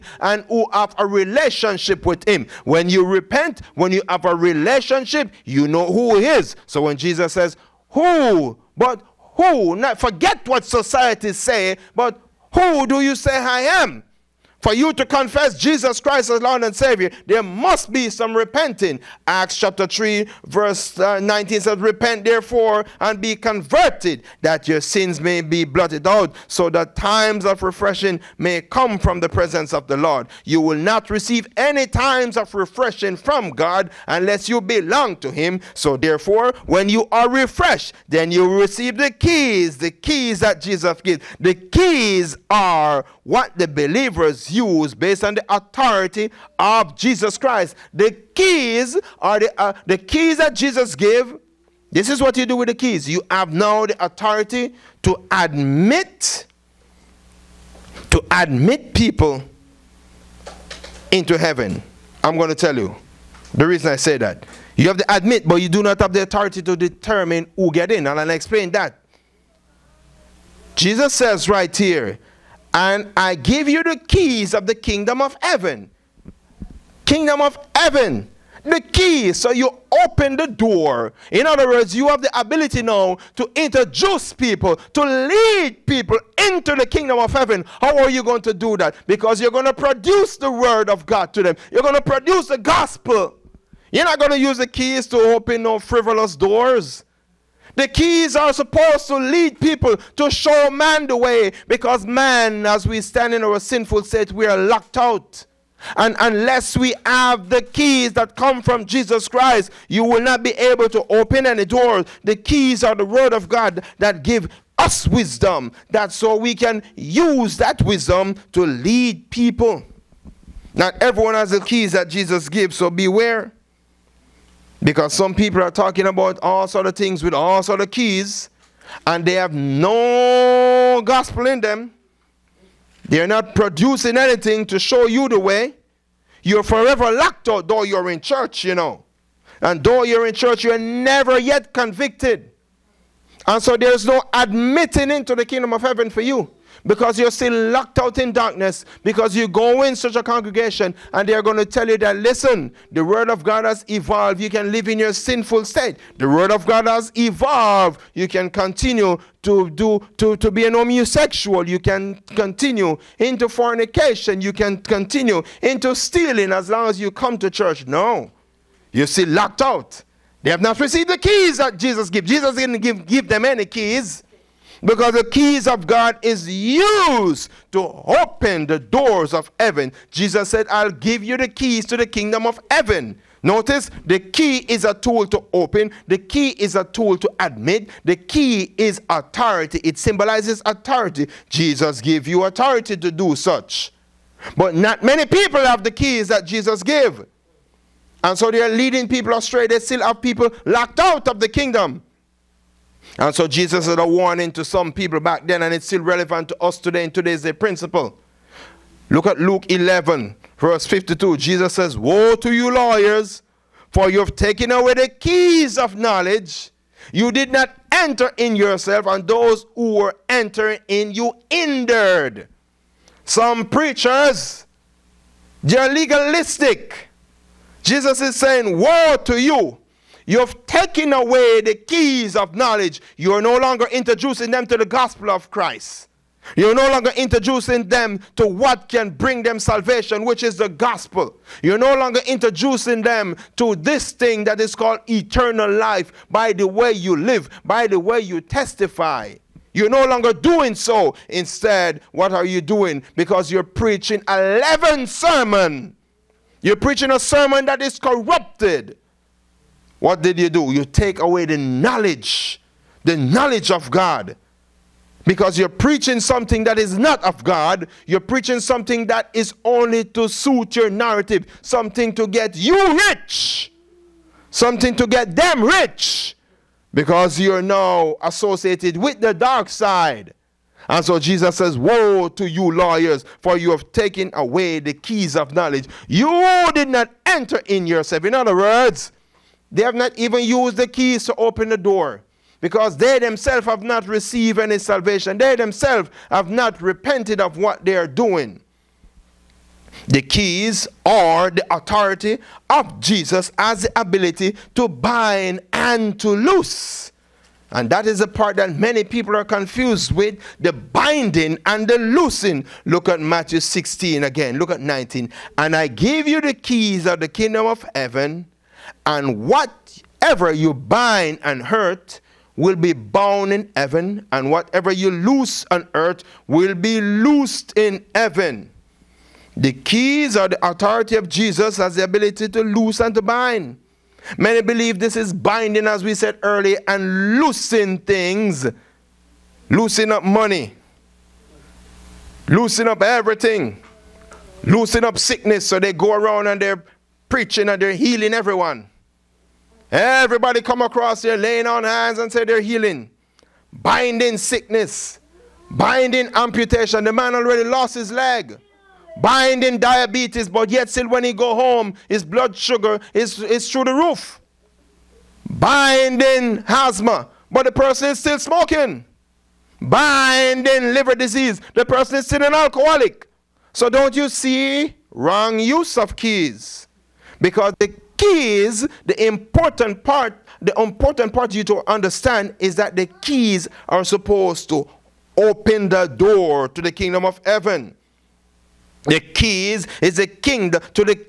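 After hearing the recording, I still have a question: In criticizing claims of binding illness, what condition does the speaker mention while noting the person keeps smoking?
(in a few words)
Asthma.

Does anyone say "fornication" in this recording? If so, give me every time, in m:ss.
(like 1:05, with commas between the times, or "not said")
2:43.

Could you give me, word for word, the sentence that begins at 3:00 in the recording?
Jesus said, I'll give you the keys to the kingdom of heaven.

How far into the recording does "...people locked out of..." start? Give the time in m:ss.
3:20.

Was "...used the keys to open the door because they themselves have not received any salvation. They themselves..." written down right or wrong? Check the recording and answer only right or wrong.
right.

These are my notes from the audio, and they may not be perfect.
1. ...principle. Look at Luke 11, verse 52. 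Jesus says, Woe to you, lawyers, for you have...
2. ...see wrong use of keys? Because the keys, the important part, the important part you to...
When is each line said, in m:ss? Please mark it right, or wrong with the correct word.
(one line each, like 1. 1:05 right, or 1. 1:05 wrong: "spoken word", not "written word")
1. 3:27 right
2. 6:14 right.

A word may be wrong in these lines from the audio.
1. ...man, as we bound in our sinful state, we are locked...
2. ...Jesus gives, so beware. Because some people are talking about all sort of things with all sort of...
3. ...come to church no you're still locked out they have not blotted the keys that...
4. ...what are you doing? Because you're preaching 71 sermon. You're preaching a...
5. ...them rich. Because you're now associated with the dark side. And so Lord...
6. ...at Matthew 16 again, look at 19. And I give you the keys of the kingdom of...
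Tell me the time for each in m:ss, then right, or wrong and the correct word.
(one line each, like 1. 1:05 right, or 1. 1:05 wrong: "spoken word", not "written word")
1. 1:42 wrong: "stand", not "bound"
2. 2:02 right
3. 2:47 wrong: "received", not "blotted"
4. 4:12 wrong: "11", not "71"
5. 4:35 wrong: "Jesus", not "Lord"
6. 5:13 right.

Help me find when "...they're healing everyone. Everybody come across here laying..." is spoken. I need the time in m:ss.
5:47.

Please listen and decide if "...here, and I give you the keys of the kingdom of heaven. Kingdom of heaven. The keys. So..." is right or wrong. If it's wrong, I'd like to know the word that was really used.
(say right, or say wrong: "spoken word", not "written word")
right.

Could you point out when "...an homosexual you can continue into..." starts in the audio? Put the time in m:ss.
2:40.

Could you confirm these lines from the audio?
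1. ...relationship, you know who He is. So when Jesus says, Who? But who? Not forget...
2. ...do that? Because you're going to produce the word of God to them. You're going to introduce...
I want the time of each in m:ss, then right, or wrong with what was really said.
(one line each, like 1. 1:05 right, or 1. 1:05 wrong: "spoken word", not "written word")
1. 0:04 right
2. 1:28 wrong: "produce", not "introduce".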